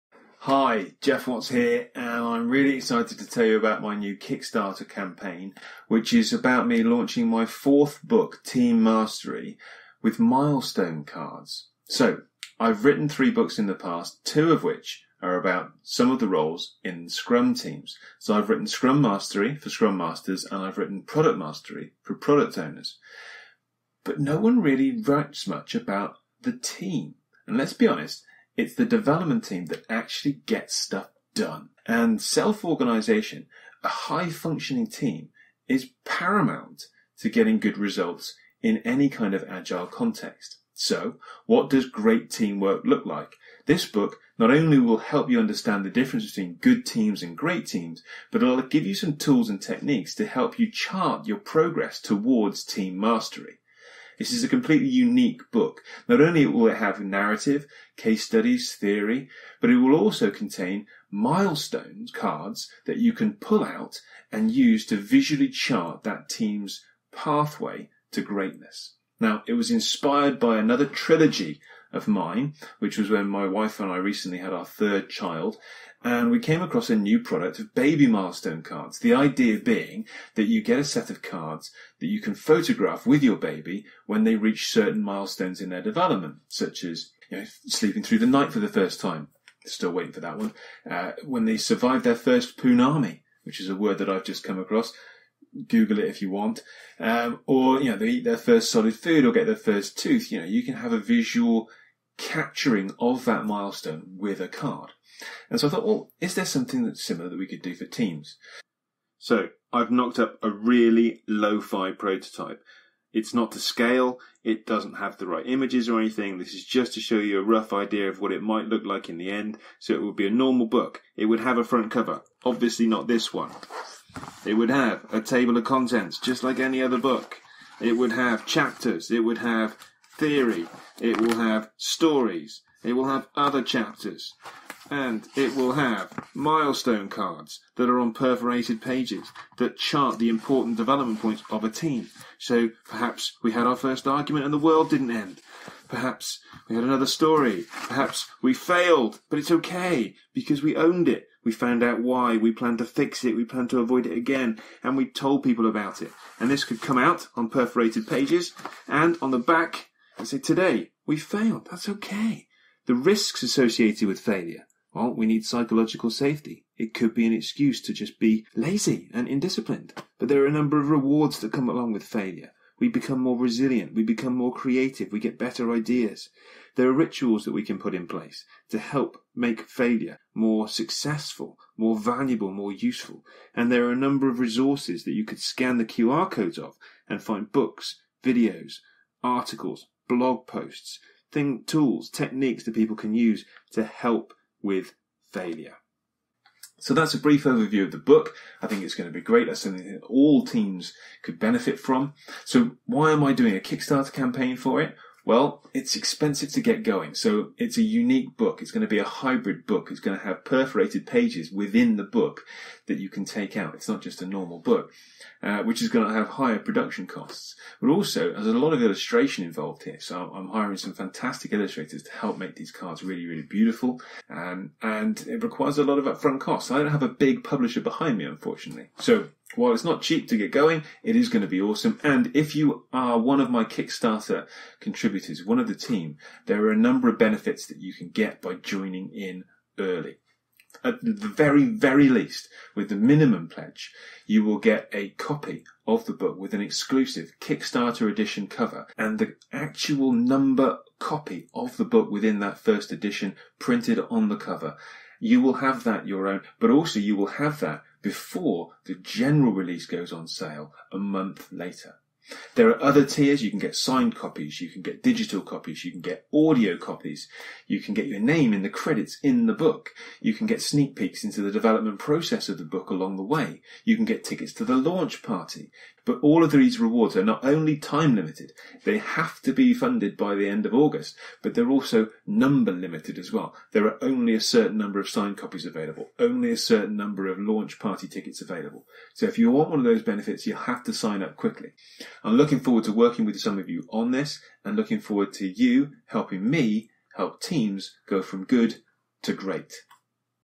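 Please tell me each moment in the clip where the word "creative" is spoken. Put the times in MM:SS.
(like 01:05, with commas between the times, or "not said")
02:54.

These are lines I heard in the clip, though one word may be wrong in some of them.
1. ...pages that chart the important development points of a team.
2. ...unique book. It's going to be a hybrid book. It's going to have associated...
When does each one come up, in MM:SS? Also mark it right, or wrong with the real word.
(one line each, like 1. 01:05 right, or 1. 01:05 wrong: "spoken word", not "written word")
1. 02:18 right
2. 03:27 wrong: "perforated", not "associated".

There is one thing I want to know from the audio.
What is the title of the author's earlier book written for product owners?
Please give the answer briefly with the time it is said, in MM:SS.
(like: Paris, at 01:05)
Product Mastery, at 00:21.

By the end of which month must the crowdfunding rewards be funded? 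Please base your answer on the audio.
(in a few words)
August.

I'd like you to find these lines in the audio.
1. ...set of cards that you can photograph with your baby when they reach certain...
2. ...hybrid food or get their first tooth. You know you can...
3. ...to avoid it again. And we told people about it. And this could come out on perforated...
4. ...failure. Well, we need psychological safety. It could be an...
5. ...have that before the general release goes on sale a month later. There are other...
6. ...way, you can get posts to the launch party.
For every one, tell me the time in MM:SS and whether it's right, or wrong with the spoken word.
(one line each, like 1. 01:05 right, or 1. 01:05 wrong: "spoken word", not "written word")
1. 01:20 right
2. 01:38 wrong: "solid", not "hybrid"
3. 02:33 right
4. 02:44 right
5. 04:17 right
6. 04:33 wrong: "tickets", not "posts".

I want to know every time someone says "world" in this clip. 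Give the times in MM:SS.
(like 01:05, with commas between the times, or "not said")
02:24.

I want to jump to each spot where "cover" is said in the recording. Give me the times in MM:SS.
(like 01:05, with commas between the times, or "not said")
02:01, 04:08, 04:14.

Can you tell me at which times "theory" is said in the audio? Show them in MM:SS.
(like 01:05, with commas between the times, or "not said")
00:58, 02:10.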